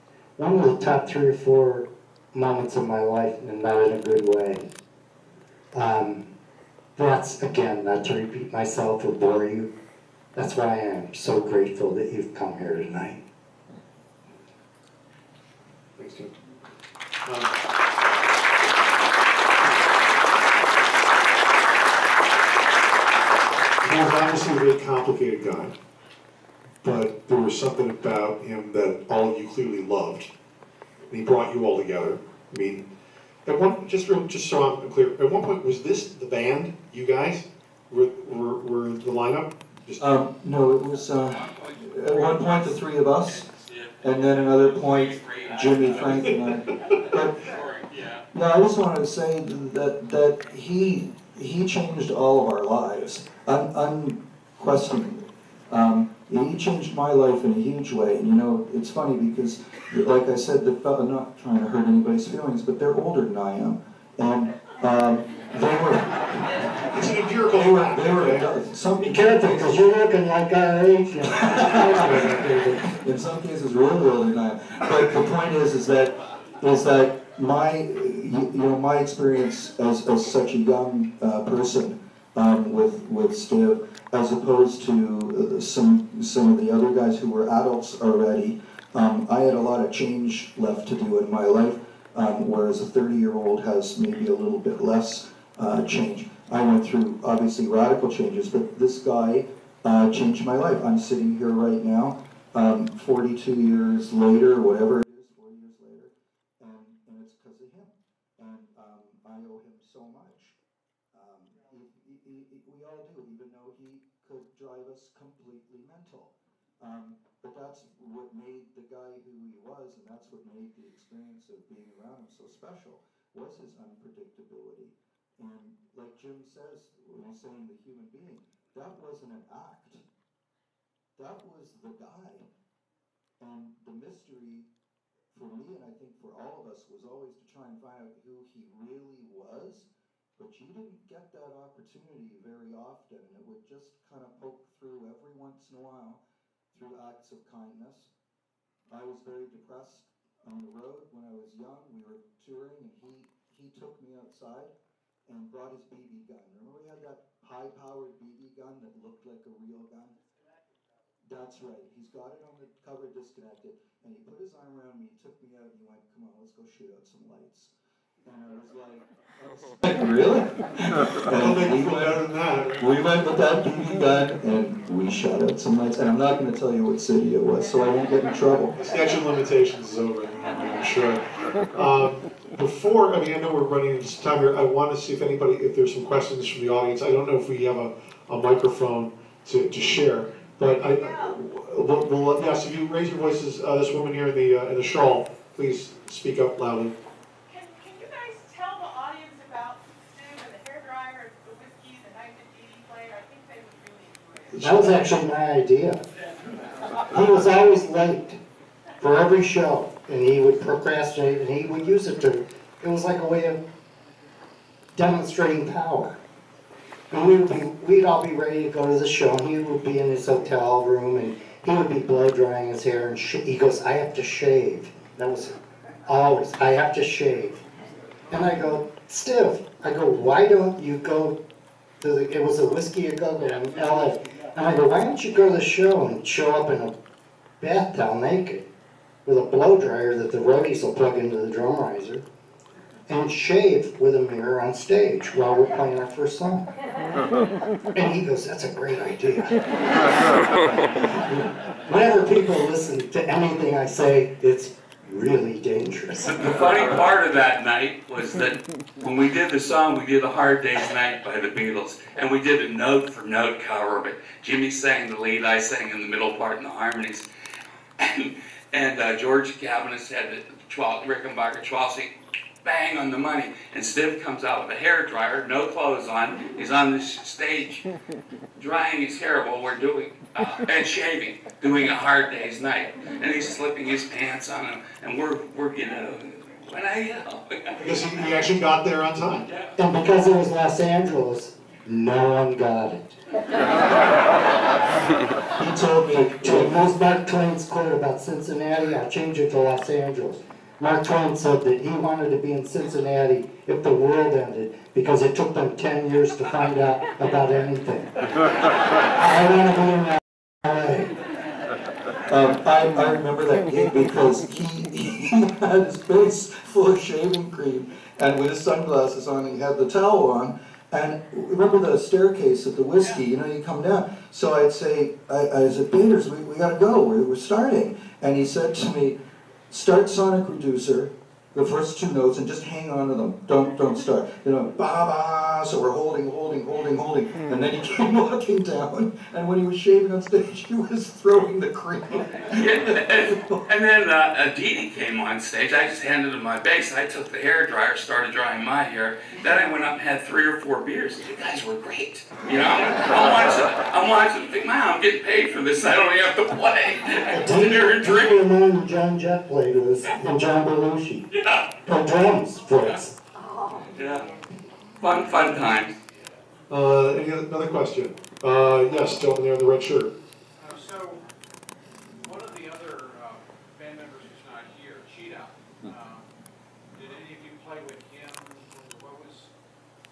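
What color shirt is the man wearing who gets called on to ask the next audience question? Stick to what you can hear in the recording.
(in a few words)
Red.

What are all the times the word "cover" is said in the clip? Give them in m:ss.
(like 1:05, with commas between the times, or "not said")
2:42, 4:23.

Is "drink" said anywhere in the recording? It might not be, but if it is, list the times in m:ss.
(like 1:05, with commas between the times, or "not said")
5:58.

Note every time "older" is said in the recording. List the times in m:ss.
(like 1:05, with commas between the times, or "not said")
1:02, 1:14.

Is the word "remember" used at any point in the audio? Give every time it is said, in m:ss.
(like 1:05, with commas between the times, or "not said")
2:36, 5:13, 5:21.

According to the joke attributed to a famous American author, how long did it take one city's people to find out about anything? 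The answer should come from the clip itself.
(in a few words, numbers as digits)
10 years.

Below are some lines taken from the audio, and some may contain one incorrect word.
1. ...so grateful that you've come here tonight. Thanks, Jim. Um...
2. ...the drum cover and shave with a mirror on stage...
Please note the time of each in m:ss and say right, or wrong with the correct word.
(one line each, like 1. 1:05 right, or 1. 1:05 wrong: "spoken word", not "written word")
1. 0:11 right
2. 4:01 wrong: "riser", not "cover".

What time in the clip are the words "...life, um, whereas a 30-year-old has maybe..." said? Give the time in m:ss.
1:31.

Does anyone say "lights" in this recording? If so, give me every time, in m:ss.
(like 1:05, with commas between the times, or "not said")
2:47, 2:55.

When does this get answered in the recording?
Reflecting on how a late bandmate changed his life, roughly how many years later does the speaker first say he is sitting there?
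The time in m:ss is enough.
1:42.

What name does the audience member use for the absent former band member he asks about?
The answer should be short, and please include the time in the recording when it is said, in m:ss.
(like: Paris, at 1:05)
Cheetah, at 6:15.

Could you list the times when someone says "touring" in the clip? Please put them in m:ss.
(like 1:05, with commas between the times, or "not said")
2:32.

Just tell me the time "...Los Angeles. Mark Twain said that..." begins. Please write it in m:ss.
4:59.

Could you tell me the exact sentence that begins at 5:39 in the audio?
And when he was shaving on stage, he was throwing the cream.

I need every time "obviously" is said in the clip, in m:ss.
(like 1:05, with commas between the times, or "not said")
0:24, 1:37.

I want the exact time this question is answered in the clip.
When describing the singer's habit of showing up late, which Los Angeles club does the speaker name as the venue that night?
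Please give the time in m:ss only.
3:52.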